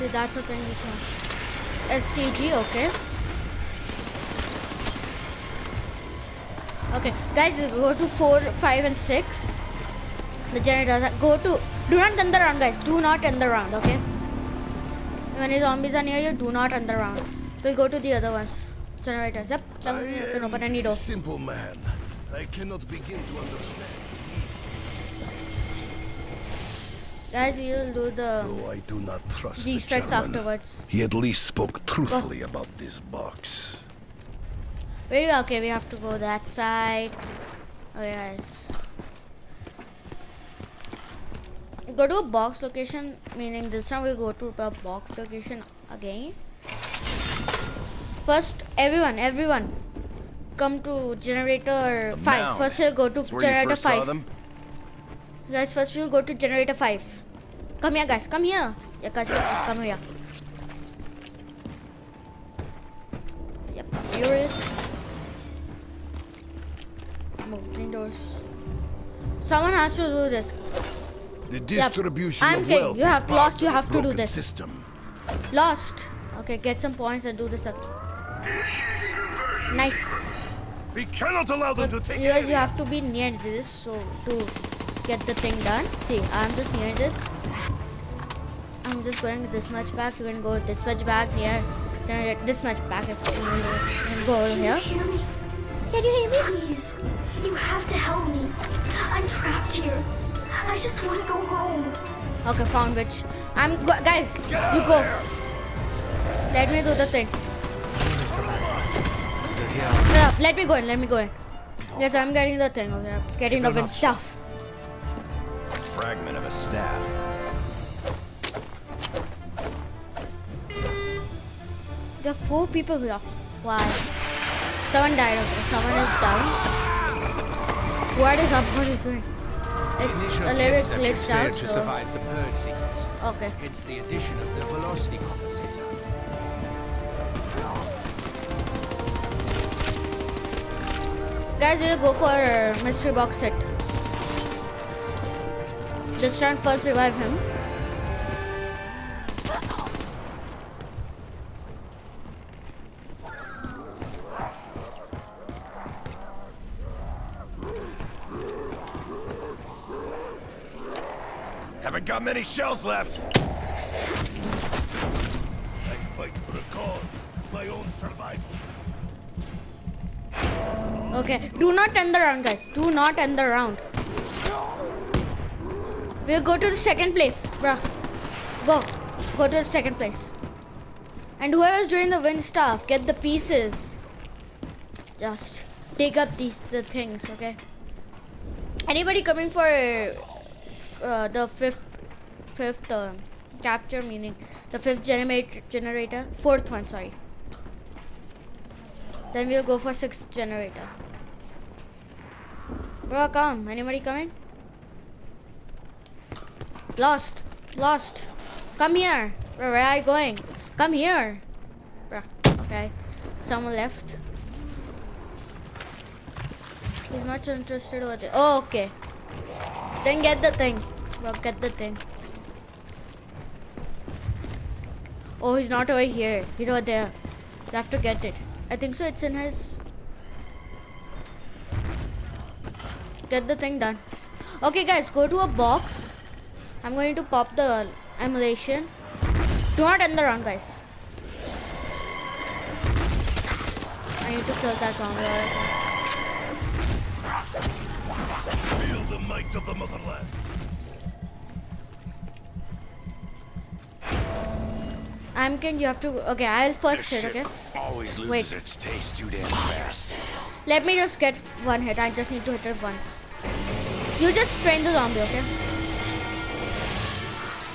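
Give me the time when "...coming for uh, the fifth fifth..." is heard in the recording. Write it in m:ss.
3:09.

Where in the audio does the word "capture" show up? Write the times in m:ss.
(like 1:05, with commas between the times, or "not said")
3:12.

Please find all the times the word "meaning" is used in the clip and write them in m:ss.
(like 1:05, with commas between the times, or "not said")
0:43, 3:14.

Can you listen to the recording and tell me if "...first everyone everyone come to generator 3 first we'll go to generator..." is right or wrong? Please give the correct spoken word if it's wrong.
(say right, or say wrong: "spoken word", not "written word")
wrong: "5", not "3".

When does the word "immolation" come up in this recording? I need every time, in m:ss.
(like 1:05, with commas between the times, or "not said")
3:58.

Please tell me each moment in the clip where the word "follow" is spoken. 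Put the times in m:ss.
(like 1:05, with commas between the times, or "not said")
not said.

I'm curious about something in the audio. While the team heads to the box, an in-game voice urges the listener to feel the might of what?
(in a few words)
The motherland.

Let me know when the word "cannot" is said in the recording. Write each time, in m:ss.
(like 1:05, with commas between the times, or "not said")
0:22, 1:21.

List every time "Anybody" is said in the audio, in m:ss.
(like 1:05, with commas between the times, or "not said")
3:08, 3:23.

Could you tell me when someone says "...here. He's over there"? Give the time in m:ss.
3:46.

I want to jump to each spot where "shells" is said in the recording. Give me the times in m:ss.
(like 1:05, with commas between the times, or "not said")
2:42.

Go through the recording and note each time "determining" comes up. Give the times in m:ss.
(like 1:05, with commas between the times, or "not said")
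not said.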